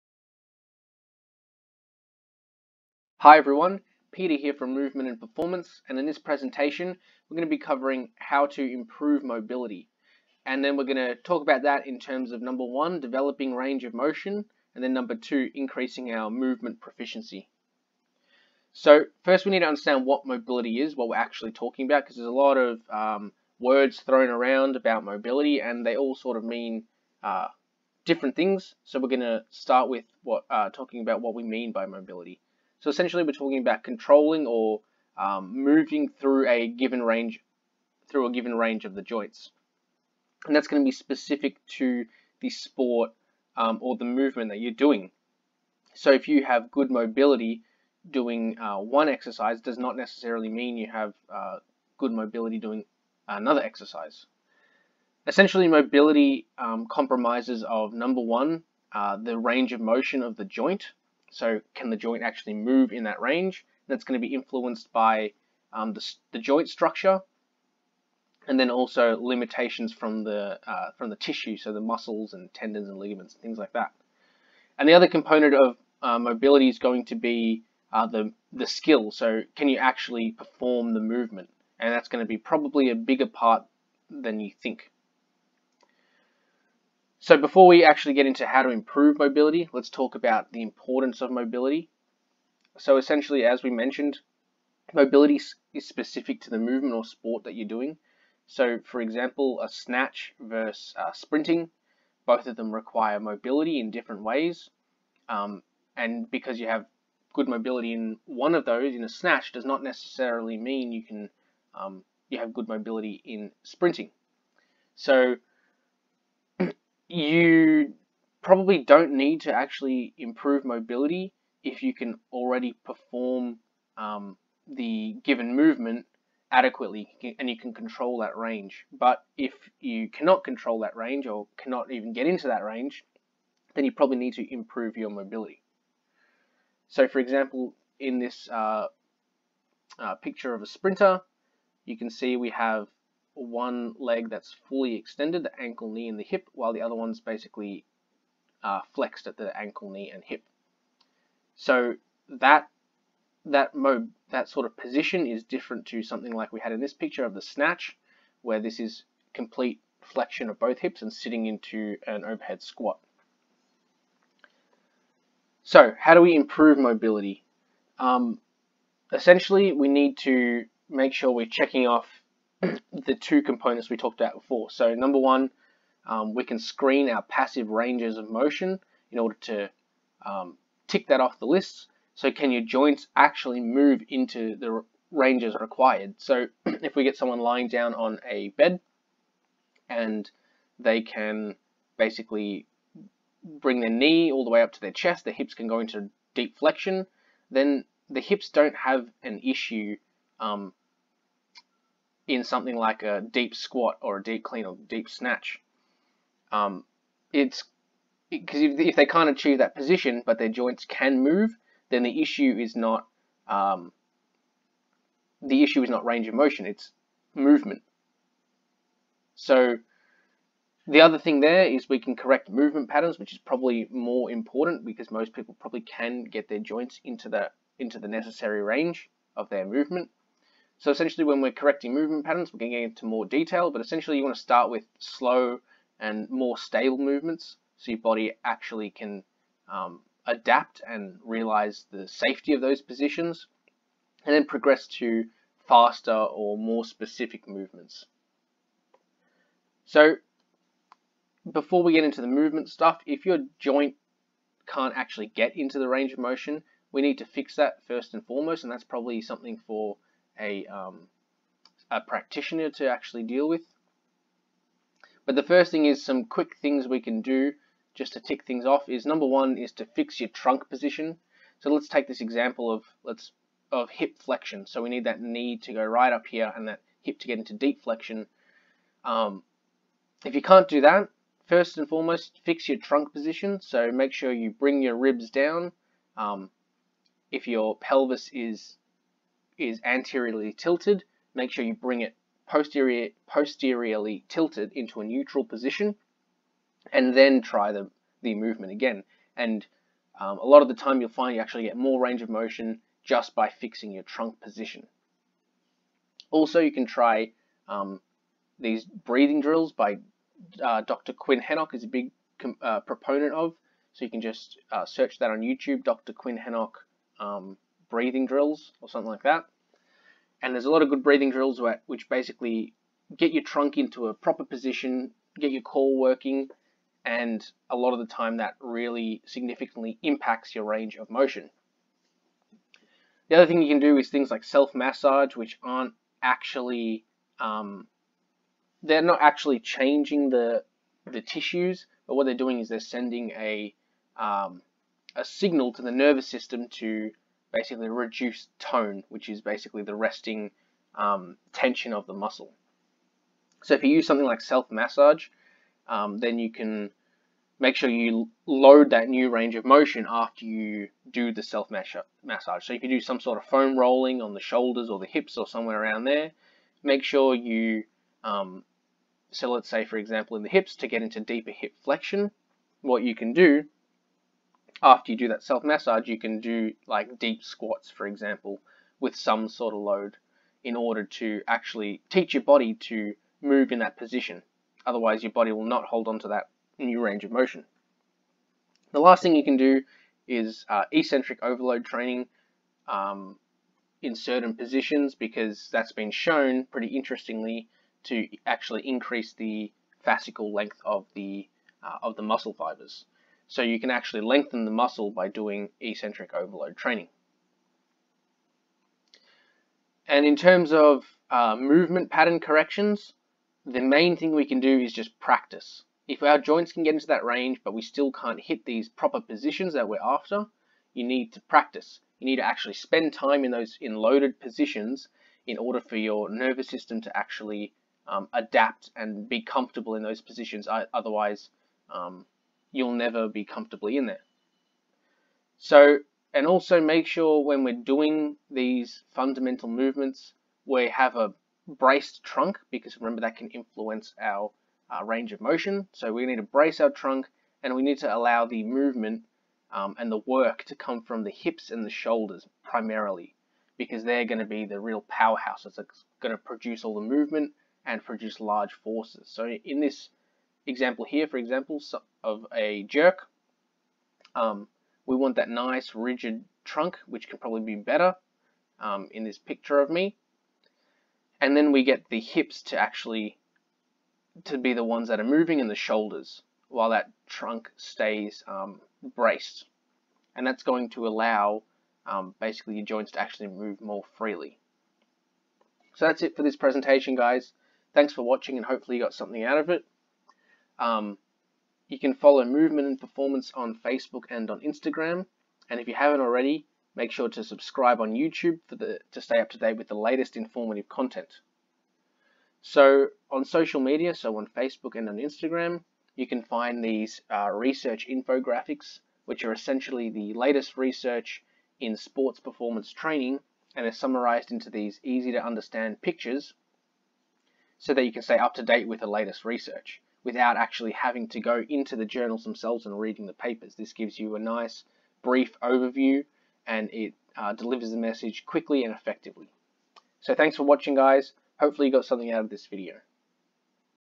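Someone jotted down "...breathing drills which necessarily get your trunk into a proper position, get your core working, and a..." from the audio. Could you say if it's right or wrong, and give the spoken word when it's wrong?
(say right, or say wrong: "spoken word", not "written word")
wrong: "basically", not "necessarily".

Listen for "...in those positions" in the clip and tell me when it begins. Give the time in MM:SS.
07:09.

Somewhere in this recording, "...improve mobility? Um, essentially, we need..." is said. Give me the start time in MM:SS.
02:46.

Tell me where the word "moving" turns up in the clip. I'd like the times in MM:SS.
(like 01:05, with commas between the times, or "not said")
00:35, 07:55.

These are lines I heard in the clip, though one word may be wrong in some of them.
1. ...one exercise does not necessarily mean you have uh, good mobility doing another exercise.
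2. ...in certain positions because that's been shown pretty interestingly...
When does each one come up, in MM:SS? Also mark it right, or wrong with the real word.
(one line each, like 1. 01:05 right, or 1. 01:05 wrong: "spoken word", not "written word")
1. 00:48 right
2. 06:34 right.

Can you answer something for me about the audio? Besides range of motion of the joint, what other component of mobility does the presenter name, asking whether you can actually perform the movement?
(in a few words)
skill.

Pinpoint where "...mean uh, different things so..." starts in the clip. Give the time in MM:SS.
00:26.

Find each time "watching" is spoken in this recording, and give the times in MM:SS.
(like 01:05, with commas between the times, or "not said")
08:08, 08:50.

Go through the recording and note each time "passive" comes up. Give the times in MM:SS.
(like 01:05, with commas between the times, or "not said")
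02:57.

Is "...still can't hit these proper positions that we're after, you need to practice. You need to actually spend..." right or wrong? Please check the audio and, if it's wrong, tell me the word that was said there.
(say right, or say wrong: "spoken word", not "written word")
right.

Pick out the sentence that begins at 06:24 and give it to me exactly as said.
Otherwise, your body will not hold on to that new range of motion.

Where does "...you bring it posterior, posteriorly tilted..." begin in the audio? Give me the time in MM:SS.
04:51.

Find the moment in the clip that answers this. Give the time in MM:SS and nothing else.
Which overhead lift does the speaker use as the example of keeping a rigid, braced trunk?
07:42.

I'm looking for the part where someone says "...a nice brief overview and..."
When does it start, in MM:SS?
08:44.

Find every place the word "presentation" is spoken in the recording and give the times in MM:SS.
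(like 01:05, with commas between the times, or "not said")
00:06, 08:06.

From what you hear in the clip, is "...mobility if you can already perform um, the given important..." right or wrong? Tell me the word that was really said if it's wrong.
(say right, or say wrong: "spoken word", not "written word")
wrong: "movement", not "important".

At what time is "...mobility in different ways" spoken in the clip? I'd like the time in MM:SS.
01:43.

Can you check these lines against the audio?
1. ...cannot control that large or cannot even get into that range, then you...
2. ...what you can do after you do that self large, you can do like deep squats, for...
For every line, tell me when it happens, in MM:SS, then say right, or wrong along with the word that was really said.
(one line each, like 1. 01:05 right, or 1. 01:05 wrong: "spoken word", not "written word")
1. 02:10 wrong: "range", not "large"
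2. 06:12 wrong: "massage", not "large".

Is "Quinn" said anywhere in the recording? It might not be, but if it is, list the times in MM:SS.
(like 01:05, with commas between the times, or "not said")
05:11, 05:16.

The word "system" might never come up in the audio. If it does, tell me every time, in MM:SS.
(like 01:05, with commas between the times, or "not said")
05:46, 07:06.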